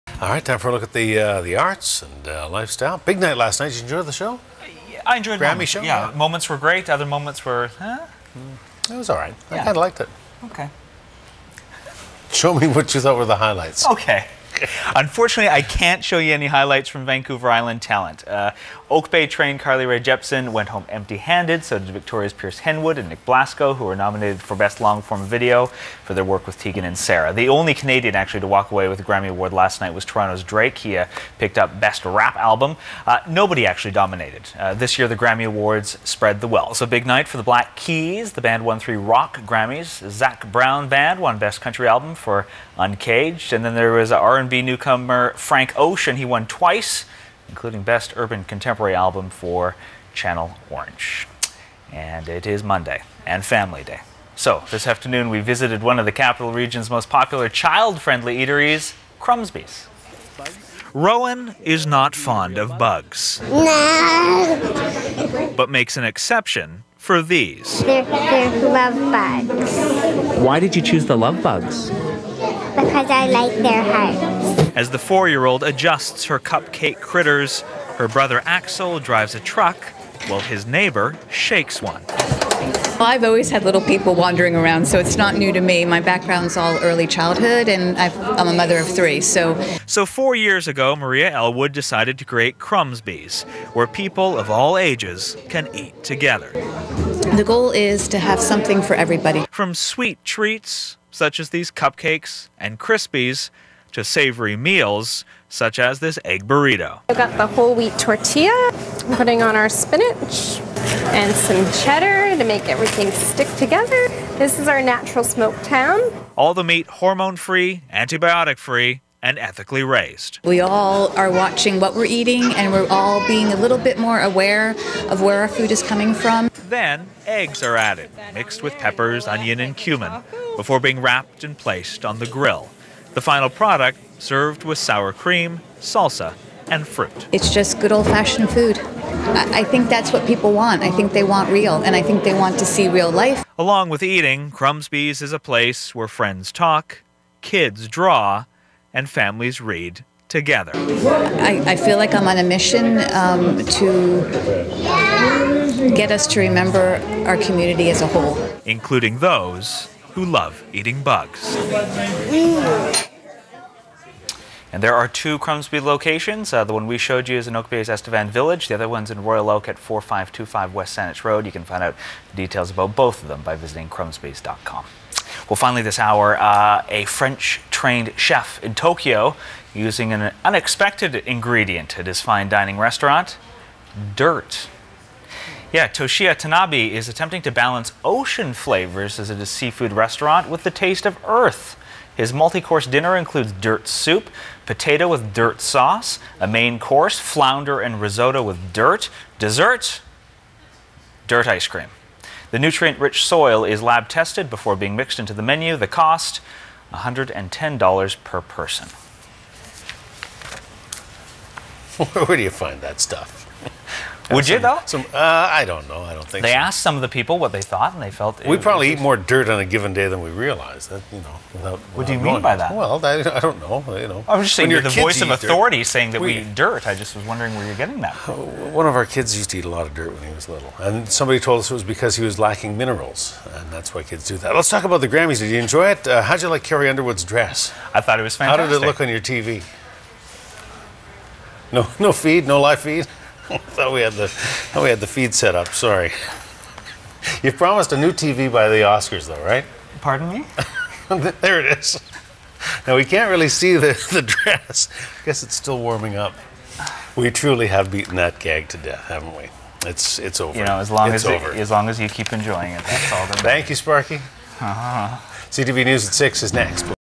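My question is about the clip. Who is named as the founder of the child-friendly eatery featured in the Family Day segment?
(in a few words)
Maria Elwood.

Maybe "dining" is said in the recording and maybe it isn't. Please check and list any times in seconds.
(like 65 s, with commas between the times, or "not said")
182 s.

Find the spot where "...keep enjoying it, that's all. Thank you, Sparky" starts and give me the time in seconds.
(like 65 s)
262 s.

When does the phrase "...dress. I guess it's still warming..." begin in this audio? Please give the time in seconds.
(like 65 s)
254 s.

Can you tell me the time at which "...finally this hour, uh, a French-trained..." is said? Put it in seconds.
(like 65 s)
175 s.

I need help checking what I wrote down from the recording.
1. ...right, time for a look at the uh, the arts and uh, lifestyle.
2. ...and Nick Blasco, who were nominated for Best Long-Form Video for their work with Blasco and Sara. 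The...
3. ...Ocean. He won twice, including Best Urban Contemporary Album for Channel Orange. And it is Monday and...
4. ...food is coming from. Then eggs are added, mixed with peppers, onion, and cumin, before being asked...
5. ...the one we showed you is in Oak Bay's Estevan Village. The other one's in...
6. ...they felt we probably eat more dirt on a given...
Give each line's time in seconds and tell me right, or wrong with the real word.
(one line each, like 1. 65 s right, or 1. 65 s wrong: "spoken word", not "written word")
1. 0 s right
2. 22 s wrong: "Tegan", not "Blasco"
3. 45 s right
4. 125 s wrong: "wrapped", not "asked"
5. 166 s right
6. 218 s right.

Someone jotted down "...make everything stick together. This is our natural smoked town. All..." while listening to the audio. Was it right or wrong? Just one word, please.
right.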